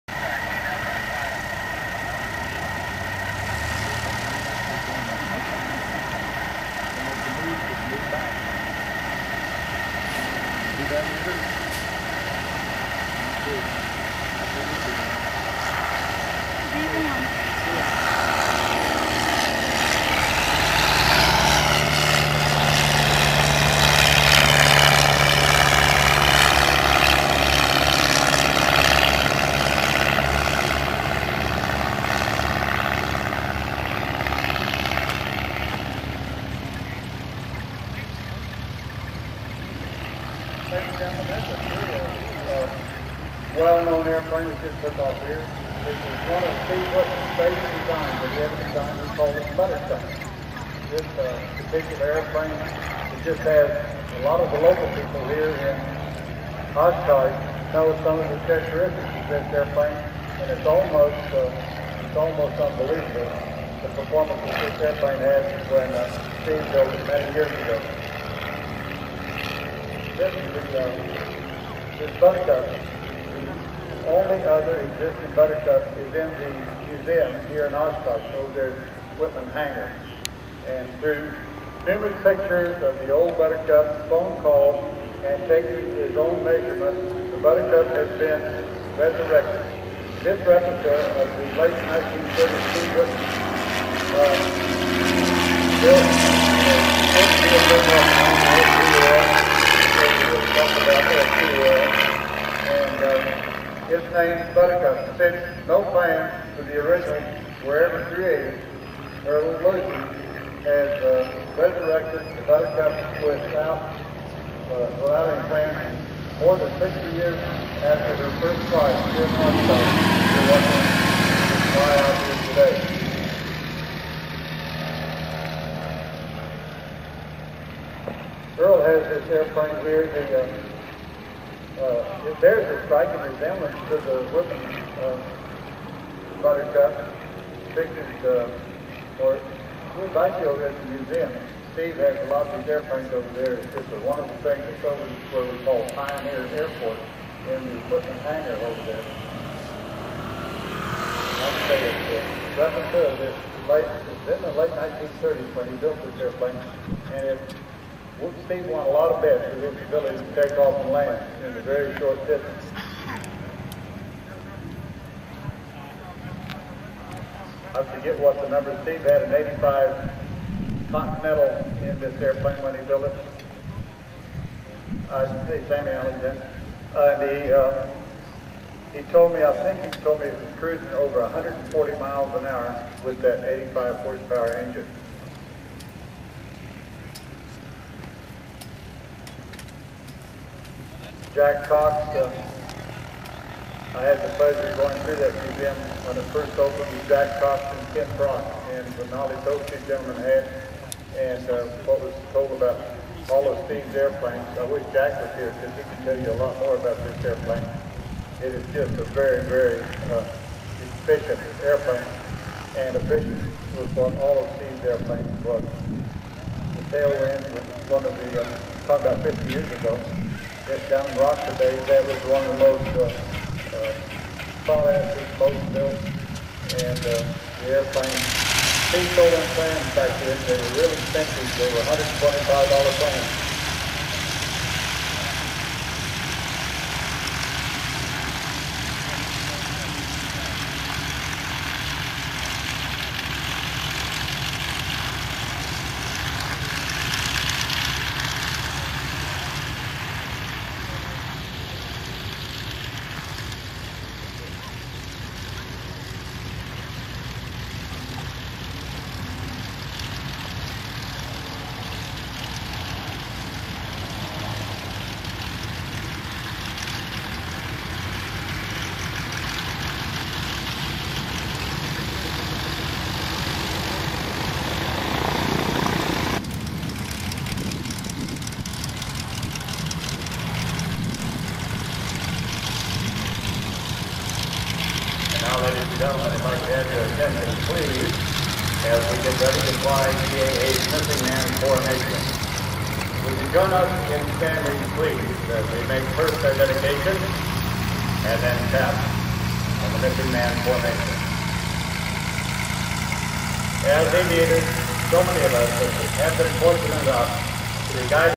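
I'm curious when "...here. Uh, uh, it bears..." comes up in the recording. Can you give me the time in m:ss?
2:09.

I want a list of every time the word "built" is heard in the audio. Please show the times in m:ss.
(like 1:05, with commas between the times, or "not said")
1:06, 1:35, 2:35, 2:52, 3:45.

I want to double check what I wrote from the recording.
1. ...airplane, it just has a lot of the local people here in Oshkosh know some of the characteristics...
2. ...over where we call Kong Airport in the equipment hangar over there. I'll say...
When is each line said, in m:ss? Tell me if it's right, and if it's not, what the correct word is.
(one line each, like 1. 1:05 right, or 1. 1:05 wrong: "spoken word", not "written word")
1. 0:52 right
2. 2:24 wrong: "Pioneer", not "Kong".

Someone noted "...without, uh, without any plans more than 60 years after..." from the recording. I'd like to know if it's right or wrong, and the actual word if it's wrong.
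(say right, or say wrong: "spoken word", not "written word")
right.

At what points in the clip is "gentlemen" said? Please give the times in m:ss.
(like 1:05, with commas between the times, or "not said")
3:19, 4:46.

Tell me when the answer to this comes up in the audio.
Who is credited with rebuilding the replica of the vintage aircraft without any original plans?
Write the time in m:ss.
1:49.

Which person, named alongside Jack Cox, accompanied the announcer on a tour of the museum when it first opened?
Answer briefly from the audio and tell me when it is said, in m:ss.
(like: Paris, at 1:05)
Ken Brock, at 3:17.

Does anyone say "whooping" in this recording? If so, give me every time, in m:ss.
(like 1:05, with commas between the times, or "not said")
2:14.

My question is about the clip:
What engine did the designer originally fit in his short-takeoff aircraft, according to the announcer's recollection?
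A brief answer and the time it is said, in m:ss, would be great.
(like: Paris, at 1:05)
85 Continental, at 2:49.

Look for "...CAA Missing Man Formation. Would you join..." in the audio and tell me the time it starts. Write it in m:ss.
4:50.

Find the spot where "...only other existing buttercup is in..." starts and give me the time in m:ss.
1:14.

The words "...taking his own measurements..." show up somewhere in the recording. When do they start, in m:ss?
1:25.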